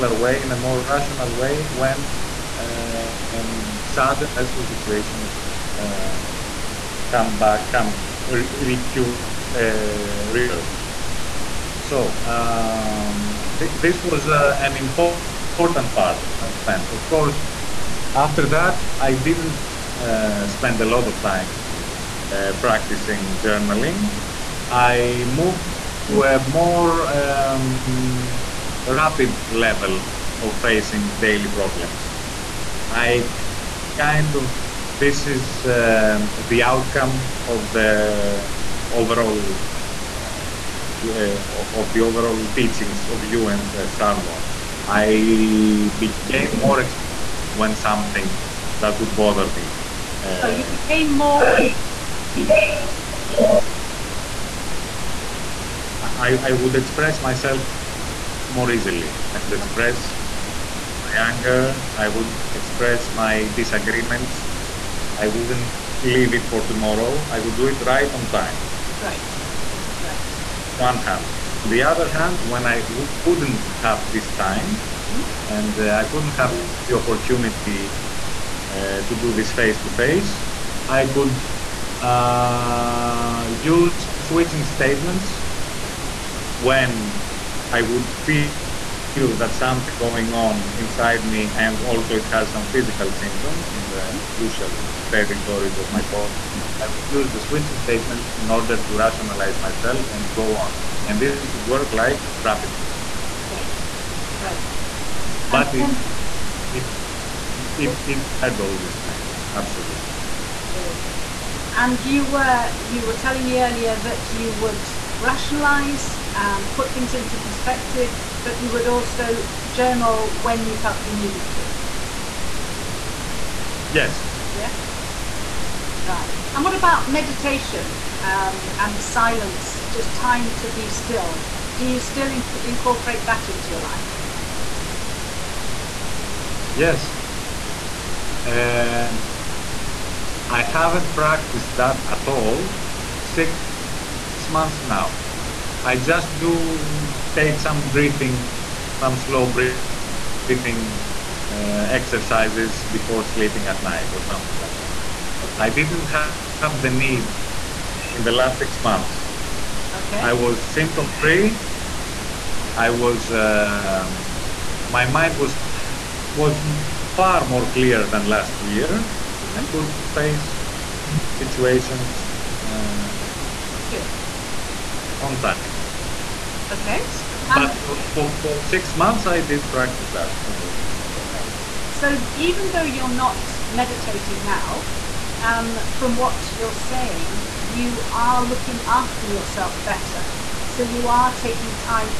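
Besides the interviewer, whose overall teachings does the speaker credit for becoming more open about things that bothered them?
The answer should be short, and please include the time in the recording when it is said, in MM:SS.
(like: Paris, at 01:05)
Sarno, at 00:43.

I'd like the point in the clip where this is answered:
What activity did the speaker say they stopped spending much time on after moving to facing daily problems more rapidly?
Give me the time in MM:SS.
00:23.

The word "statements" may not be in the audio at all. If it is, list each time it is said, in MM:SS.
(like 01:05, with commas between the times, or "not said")
01:24, 01:37.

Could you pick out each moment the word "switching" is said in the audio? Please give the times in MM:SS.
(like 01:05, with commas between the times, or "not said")
01:24, 01:37.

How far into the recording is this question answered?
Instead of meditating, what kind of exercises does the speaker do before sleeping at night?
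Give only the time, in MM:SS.
02:29.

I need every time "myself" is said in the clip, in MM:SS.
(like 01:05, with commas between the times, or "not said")
00:57, 01:39.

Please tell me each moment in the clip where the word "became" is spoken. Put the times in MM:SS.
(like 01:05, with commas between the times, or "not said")
00:45, 00:50.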